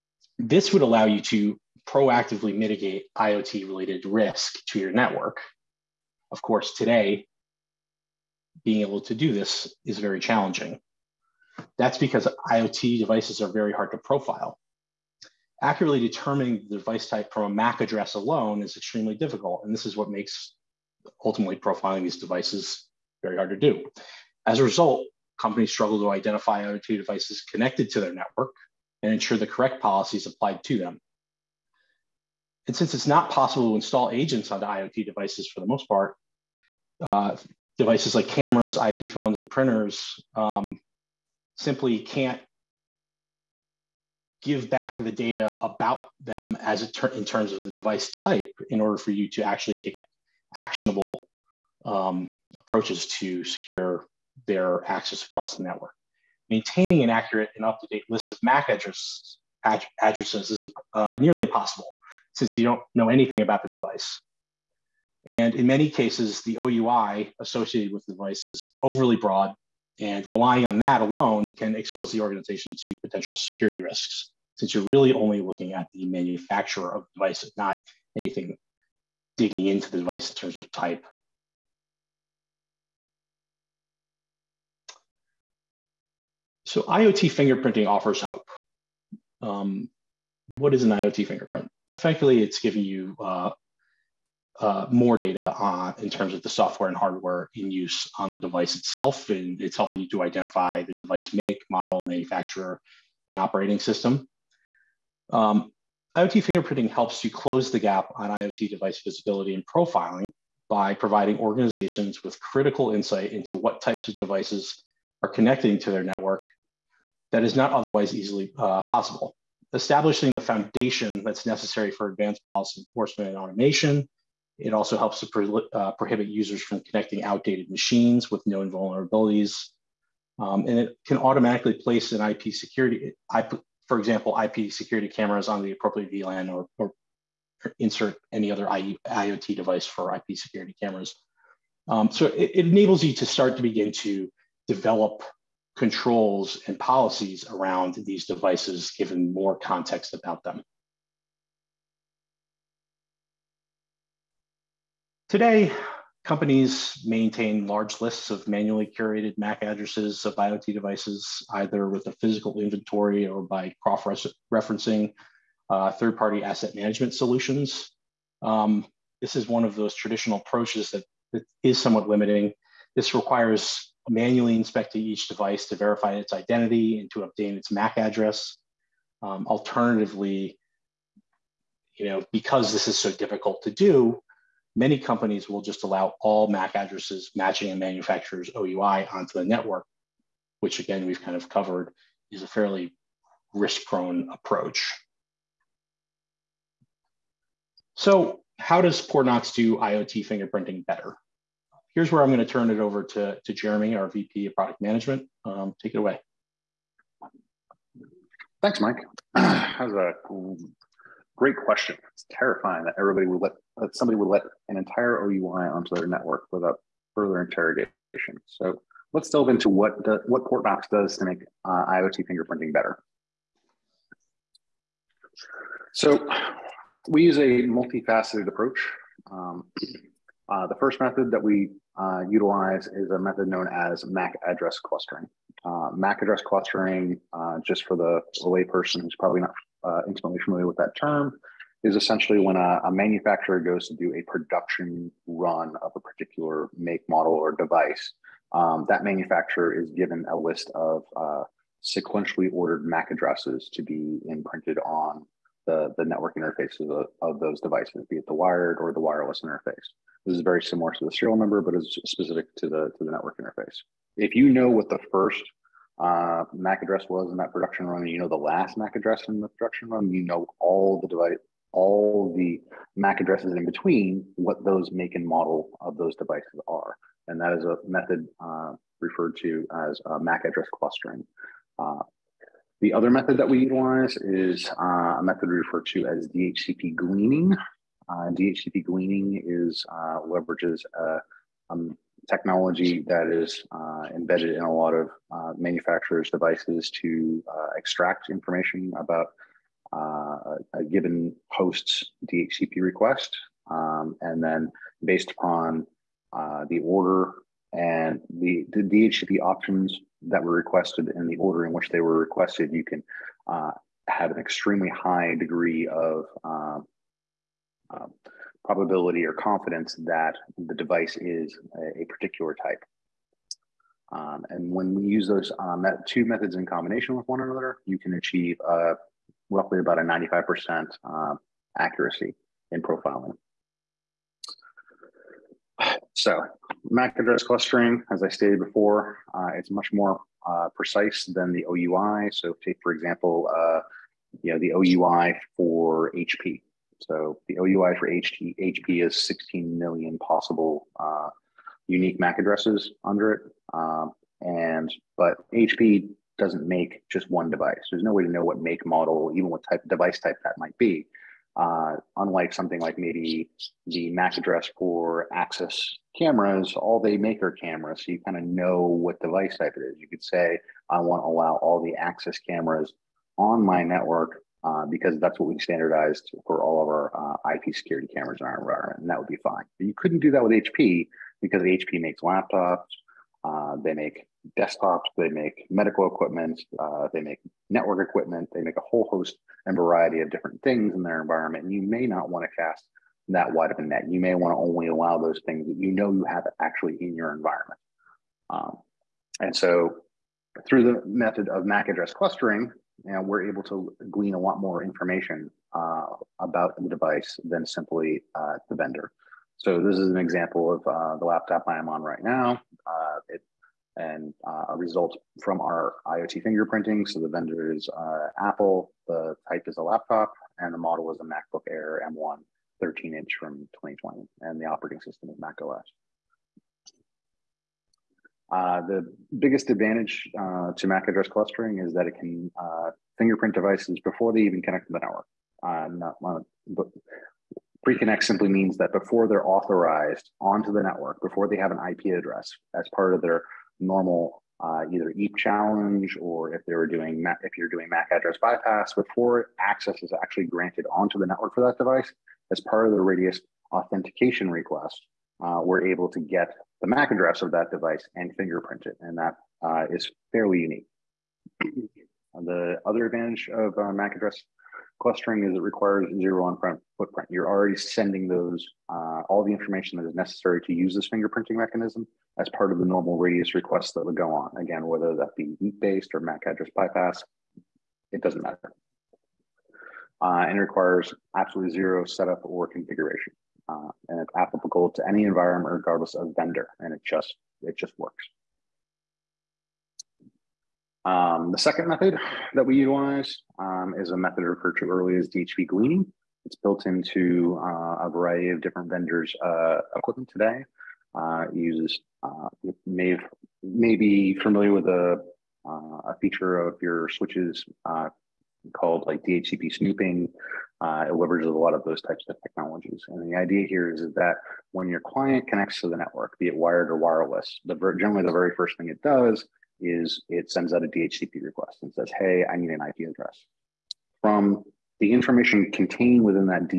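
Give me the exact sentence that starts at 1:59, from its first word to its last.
Establishing the foundation that's necessary for advanced policy enforcement and automation.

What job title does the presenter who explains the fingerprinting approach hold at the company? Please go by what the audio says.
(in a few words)
VP of Product Management.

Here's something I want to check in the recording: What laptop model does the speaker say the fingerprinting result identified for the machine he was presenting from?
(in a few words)
MacBook Air M1.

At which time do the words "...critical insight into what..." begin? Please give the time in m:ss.
1:52.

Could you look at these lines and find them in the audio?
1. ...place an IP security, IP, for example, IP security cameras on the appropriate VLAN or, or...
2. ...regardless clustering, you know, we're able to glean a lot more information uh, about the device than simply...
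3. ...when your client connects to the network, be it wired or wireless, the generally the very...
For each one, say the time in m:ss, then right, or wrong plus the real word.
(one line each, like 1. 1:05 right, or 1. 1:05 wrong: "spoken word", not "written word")
1. 2:11 right
2. 6:41 wrong: "address", not "regardless"
3. 8:34 right.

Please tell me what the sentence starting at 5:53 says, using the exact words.
Um, and, but HP doesn't make just one device.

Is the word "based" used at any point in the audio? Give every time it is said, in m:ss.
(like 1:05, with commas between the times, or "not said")
5:05, 7:55.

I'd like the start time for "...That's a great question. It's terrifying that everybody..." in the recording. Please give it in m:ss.
3:29.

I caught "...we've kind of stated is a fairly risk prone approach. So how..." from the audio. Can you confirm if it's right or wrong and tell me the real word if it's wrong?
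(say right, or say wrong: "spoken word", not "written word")
wrong: "covered", not "stated".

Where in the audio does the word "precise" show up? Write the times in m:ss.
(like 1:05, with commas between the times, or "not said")
5:40.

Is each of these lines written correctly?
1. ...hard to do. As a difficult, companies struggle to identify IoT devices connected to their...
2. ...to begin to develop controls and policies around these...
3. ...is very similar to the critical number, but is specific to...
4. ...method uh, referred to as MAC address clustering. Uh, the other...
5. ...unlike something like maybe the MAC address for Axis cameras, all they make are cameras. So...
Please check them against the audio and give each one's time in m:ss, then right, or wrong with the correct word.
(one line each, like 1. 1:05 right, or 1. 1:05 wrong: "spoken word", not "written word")
1. 0:23 wrong: "result", not "difficult"
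2. 2:23 right
3. 4:20 wrong: "serial", not "critical"
4. 4:37 right
5. 6:02 right.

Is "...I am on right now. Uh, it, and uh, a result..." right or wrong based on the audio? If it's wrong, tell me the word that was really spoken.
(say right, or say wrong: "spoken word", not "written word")
right.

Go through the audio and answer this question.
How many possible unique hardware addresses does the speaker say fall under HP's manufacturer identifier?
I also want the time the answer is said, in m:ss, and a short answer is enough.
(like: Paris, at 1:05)
16 million, at 5:49.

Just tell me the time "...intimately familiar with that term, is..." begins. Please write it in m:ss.
4:00.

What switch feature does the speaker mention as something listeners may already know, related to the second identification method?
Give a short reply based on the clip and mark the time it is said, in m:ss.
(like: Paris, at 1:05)
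DHCP snooping, at 8:29.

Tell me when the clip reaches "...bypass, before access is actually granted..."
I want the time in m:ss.
7:28.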